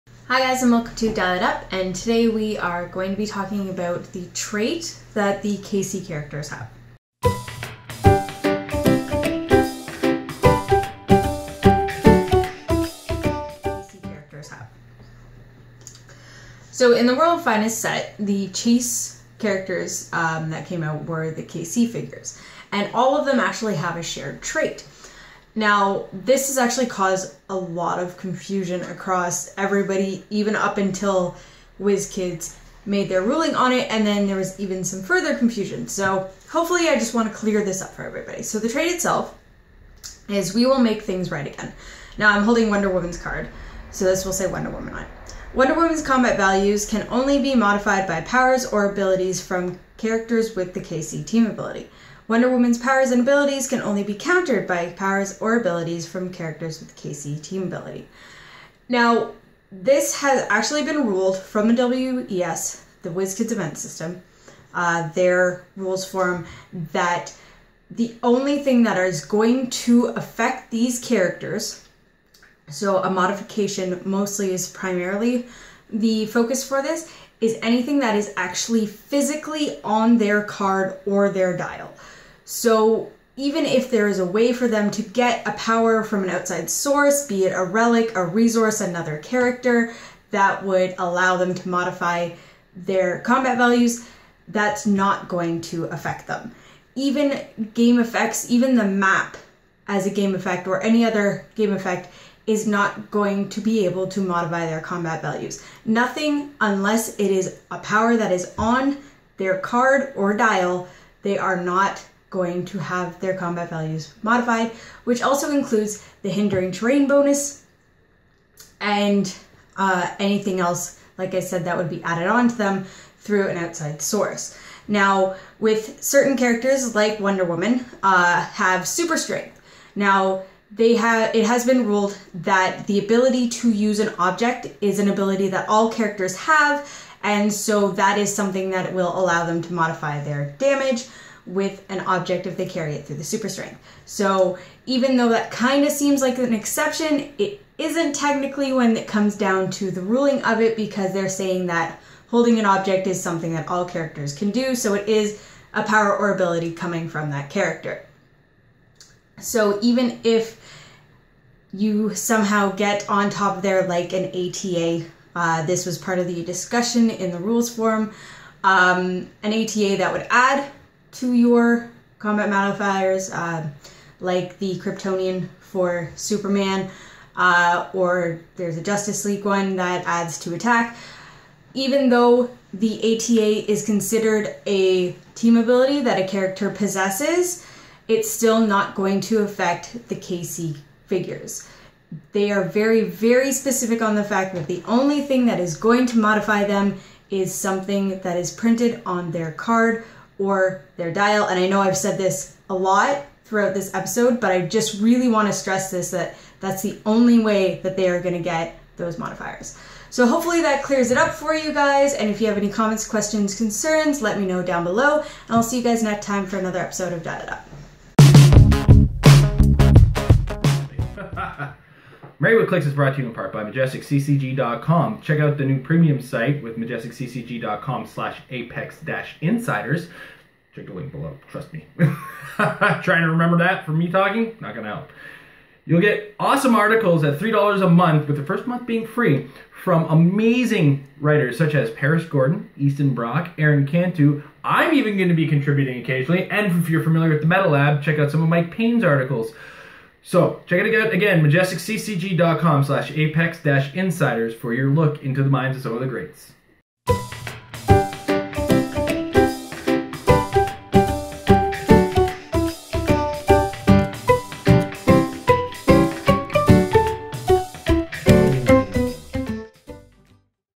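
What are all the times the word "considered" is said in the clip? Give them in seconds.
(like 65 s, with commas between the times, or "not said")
183 s.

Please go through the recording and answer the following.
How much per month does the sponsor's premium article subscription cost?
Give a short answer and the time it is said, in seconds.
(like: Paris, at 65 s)
$3, at 237 s.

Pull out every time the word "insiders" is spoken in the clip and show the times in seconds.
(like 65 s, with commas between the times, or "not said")
229 s, 253 s.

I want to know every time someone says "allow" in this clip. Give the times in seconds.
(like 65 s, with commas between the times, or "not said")
90 s, 139 s.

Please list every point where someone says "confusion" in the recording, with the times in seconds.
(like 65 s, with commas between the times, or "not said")
28 s, 35 s.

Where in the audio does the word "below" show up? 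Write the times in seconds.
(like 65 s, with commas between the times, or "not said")
214 s, 231 s.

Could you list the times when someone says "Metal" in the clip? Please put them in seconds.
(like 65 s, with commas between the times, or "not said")
247 s.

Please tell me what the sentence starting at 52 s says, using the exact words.
Wonder Woman's powers and abilities can only be countered by powers or abilities from characters with KC team ability.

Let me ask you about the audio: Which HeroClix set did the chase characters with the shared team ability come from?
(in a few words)
World Finest.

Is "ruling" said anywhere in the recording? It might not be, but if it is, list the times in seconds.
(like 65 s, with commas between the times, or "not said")
33 s, 150 s.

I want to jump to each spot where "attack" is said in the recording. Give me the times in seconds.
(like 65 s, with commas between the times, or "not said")
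180 s.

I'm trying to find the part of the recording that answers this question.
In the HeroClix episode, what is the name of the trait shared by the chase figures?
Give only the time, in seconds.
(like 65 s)
40 s.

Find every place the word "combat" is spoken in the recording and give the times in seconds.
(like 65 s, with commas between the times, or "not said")
46 s, 93 s, 104 s, 113 s, 172 s.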